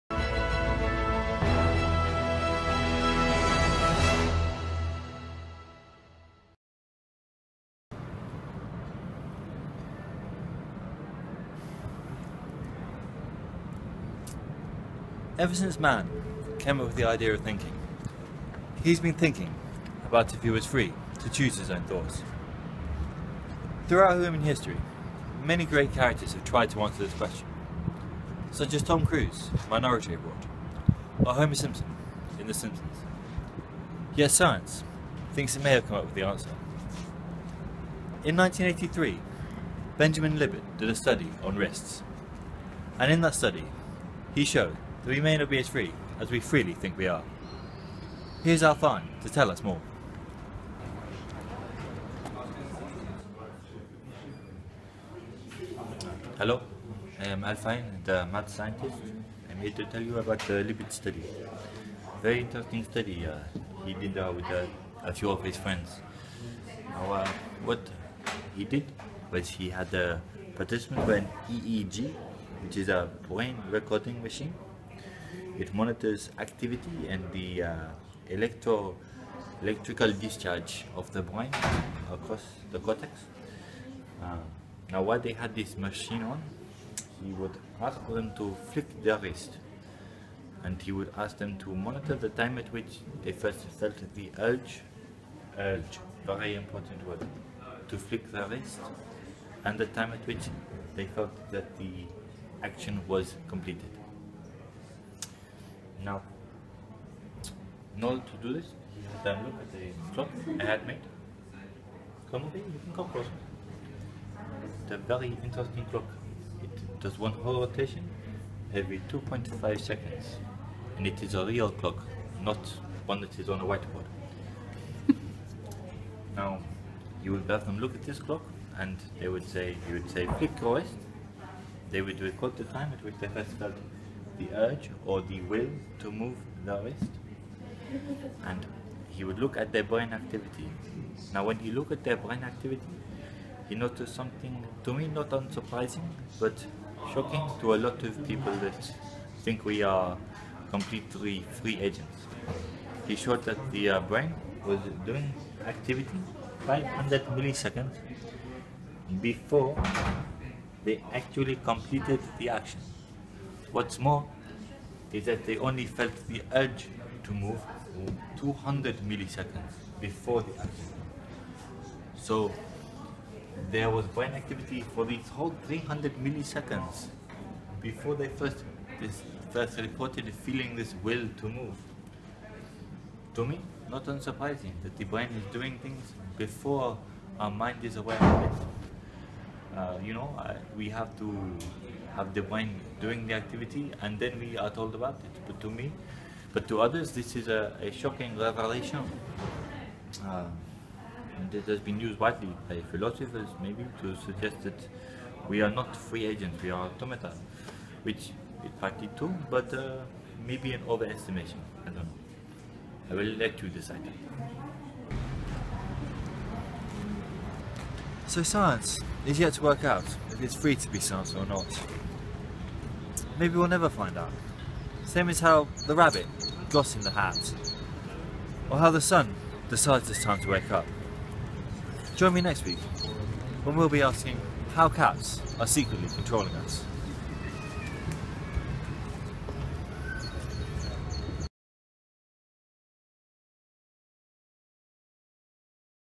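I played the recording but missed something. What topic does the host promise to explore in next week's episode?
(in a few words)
How cats are secretly controlling us.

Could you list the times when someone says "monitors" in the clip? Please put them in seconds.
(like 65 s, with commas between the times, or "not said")
75 s, 91 s.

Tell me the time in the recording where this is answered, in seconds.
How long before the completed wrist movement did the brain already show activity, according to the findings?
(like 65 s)
156 s.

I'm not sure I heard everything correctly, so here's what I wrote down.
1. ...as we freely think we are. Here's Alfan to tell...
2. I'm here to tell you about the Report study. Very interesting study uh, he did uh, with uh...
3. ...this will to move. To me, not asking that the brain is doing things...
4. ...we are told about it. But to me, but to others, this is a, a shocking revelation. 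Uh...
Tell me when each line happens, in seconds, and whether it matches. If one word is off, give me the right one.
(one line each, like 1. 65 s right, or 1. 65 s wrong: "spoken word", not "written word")
1. 46 s right
2. 59 s wrong: "Libet", not "Report"
3. 180 s wrong: "unsurprising", not "asking"
4. 194 s right.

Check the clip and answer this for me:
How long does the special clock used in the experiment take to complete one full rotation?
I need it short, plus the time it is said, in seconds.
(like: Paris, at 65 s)
2.5 seconds, at 119 s.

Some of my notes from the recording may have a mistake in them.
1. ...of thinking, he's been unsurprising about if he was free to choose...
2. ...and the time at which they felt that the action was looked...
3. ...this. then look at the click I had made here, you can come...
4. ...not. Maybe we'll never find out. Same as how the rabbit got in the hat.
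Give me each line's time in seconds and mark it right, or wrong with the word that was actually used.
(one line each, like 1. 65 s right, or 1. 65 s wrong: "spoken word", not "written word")
1. 17 s wrong: "thinking", not "unsurprising"
2. 99 s wrong: "completed", not "looked"
3. 108 s wrong: "clock", not "click"
4. 221 s right.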